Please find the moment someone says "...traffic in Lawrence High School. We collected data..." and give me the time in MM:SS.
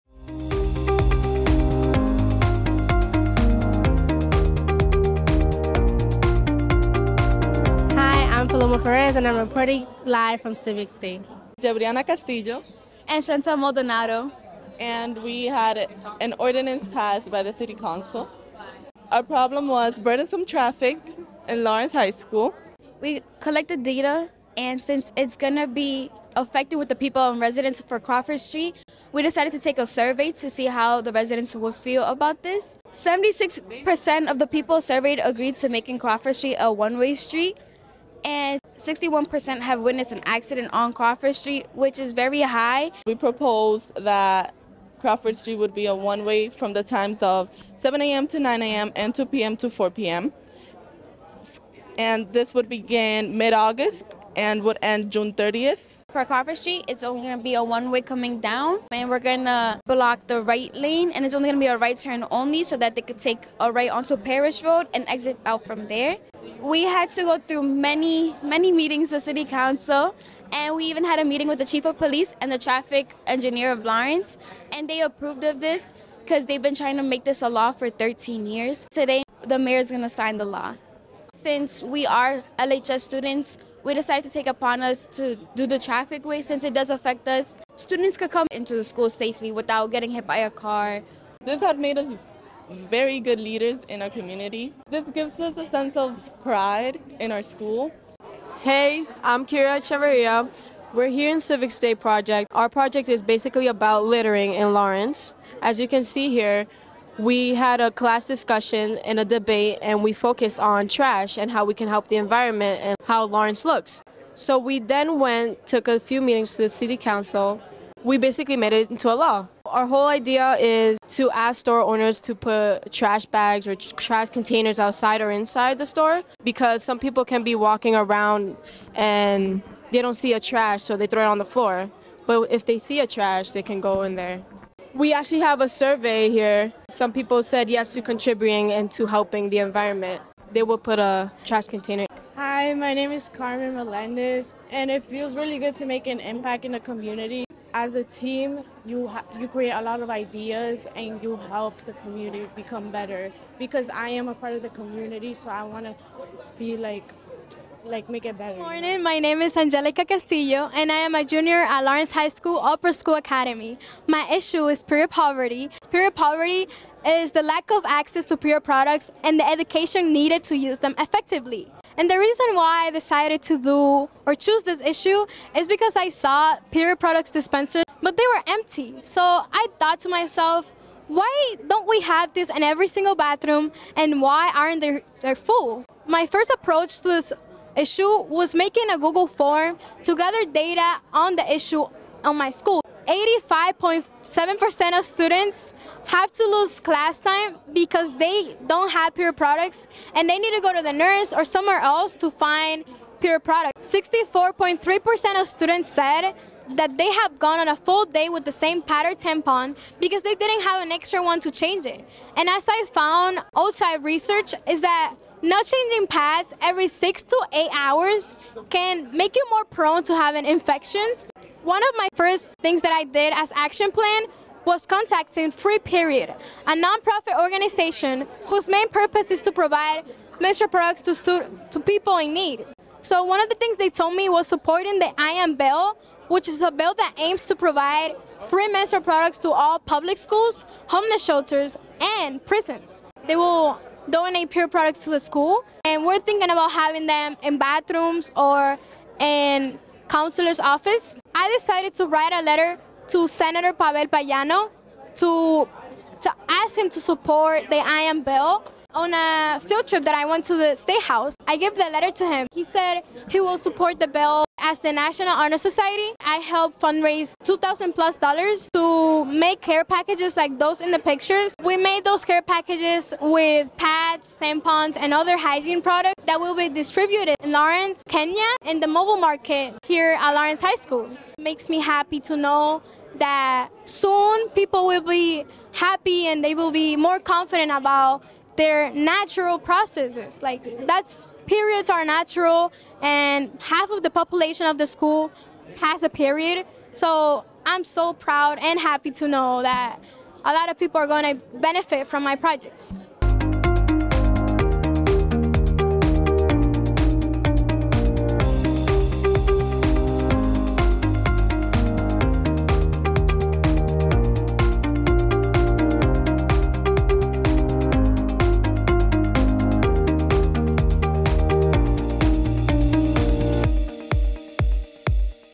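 00:20.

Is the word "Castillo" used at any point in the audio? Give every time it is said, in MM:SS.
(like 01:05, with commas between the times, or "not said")
00:12, 02:40.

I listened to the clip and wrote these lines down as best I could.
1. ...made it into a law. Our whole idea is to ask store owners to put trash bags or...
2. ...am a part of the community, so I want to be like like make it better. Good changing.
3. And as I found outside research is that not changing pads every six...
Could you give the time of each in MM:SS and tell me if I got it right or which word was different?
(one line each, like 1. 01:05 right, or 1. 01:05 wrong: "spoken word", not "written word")
1. 01:58 right
2. 02:34 wrong: "morning", not "changing"
3. 03:32 right.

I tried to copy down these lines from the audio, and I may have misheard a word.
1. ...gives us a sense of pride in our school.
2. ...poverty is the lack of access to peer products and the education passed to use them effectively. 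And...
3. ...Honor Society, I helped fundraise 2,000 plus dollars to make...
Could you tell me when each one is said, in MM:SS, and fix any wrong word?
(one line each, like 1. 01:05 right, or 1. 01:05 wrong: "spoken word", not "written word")
1. 01:35 right
2. 02:46 wrong: "needed", not "passed"
3. 04:25 right.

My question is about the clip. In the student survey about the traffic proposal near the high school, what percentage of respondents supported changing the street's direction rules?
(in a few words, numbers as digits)
76%.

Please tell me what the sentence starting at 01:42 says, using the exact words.
Our project is basically about littering in Lawrence.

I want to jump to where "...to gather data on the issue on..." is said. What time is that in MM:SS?
03:10.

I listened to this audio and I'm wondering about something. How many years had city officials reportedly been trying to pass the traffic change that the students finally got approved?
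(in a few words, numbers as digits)
13 years.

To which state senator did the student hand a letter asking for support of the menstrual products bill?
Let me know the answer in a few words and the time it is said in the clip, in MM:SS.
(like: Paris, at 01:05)
Pavel Payano, at 04:13.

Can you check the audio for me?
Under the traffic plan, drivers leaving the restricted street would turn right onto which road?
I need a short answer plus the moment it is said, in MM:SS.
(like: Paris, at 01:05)
Parish Road, at 01:04.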